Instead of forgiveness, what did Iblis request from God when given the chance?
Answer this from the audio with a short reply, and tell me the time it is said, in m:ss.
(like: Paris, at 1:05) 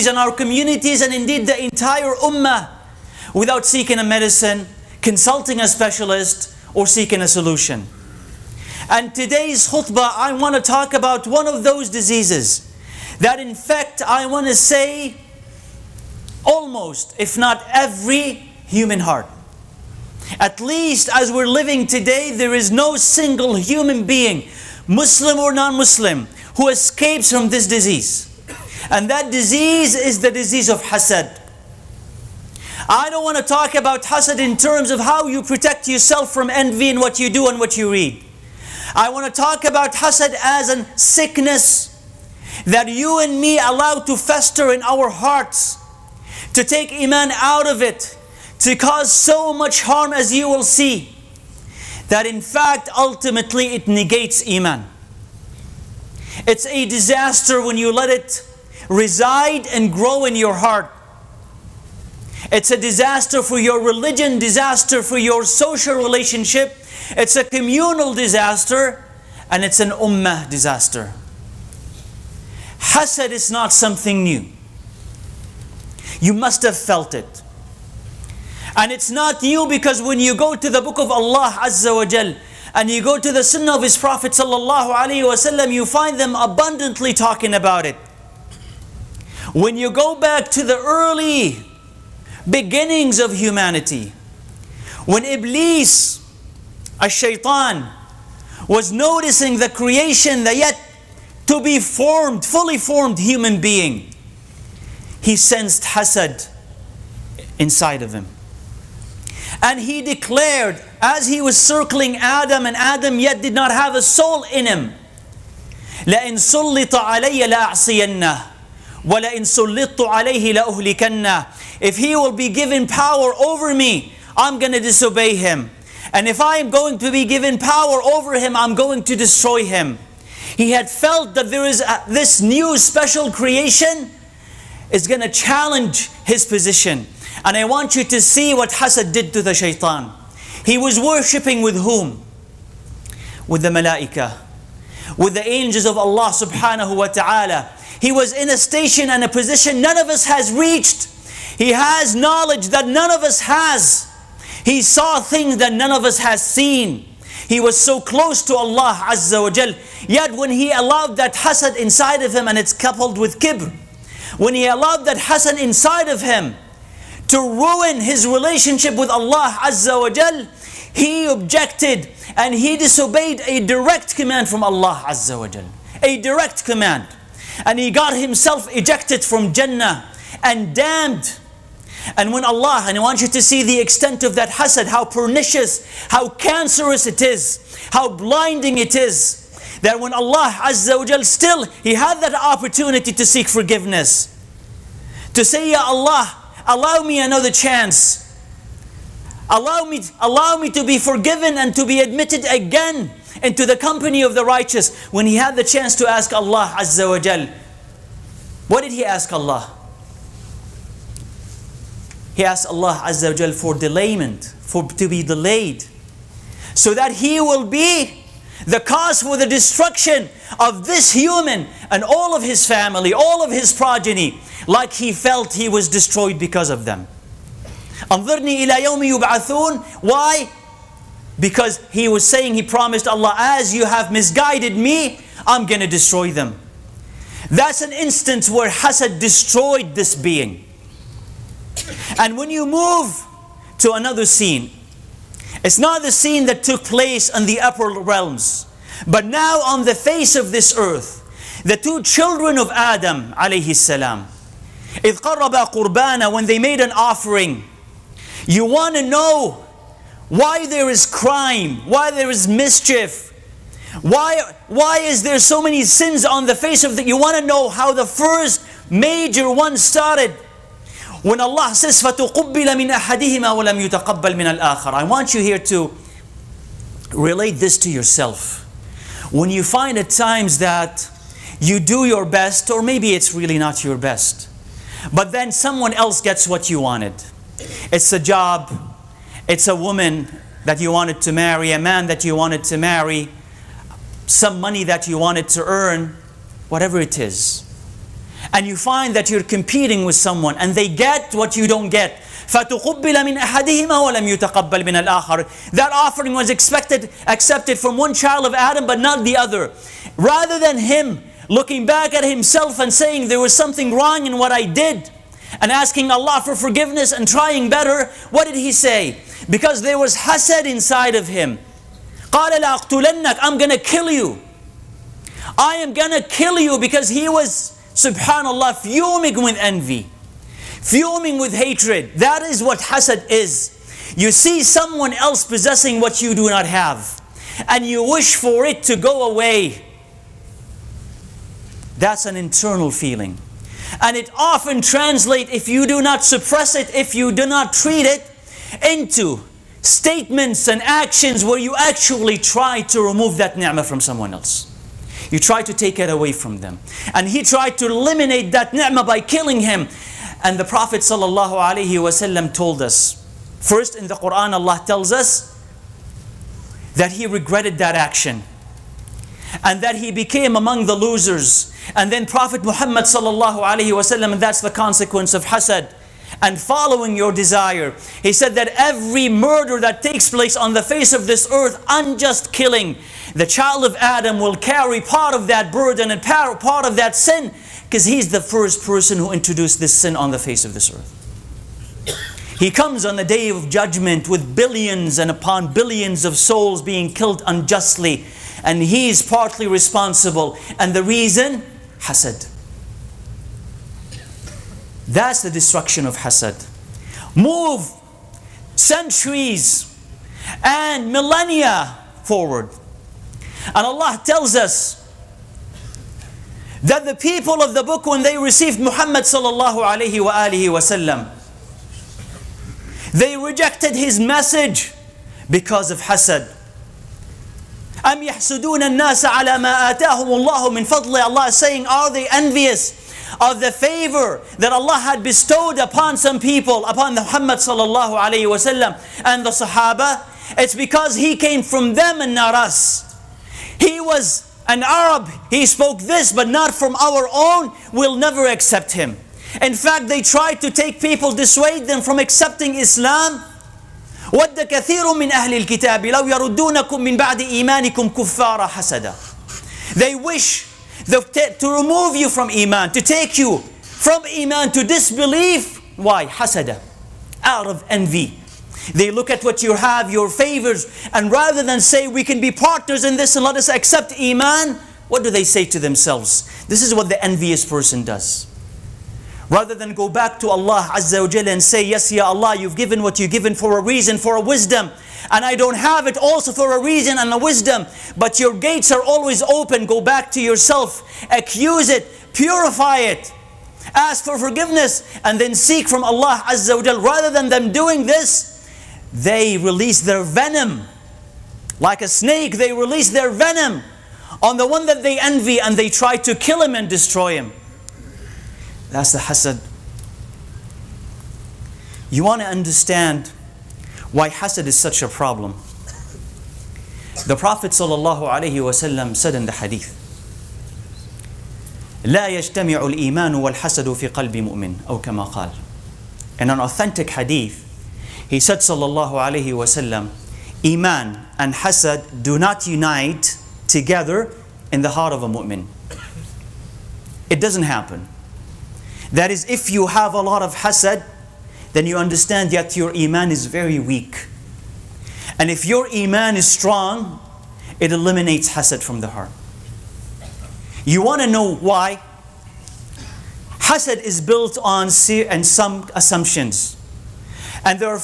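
delayment, at 3:33.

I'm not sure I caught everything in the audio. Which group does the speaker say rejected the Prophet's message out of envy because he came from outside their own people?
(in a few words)
the people of the book.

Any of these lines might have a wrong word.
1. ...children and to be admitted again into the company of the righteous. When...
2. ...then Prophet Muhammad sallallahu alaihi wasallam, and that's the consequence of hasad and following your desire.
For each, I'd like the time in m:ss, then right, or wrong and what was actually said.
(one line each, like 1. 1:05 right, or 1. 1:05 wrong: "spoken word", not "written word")
1. 3:20 wrong: "forgiven", not "children"
2. 6:12 right.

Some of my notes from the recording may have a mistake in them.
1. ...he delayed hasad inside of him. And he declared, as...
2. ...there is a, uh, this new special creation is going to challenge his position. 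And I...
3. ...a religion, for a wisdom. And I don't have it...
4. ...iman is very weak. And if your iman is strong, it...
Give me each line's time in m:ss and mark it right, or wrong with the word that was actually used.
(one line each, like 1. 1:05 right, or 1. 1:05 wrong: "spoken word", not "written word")
1. 1:45 wrong: "sensed", not "delayed"
2. 2:11 right
3. 8:03 wrong: "reason", not "religion"
4. 9:02 right.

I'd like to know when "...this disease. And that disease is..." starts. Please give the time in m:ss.
0:27.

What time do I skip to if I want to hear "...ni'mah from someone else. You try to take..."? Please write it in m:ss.
5:53.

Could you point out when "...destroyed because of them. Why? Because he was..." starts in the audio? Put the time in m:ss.
3:45.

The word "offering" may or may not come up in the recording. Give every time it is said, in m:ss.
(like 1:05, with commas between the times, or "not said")
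4:16, 5:05.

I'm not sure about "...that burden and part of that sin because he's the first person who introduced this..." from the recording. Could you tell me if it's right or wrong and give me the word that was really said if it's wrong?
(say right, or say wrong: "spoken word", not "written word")
right.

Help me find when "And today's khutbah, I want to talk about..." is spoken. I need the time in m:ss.
0:08.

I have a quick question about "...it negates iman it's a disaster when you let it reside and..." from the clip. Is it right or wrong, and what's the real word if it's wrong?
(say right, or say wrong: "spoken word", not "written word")
right.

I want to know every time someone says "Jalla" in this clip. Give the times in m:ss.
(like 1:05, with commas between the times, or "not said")
8:01, 8:16.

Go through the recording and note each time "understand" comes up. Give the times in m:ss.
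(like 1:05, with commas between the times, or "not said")
8:32, 9:01.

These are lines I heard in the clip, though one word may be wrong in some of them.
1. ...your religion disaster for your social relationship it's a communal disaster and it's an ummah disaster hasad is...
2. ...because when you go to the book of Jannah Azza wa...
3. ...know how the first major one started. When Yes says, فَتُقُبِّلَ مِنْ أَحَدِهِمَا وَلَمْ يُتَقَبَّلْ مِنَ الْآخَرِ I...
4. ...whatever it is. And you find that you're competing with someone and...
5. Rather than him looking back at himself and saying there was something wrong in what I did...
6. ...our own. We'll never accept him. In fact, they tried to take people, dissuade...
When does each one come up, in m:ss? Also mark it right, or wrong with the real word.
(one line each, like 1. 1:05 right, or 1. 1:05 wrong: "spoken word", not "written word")
1. 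1:03 right
2. 1:19 wrong: "Allah", not "Jannah"
3. 4:27 wrong: "Allah", not "Yes"
4. 4:56 right
5. 5:10 right
6. 7:26 right.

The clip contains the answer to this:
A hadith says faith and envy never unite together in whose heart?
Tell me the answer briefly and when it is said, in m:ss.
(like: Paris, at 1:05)
a mu'min, at 8:55.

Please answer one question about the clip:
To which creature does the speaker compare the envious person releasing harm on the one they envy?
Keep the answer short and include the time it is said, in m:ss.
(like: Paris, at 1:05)
a snake, at 8:22.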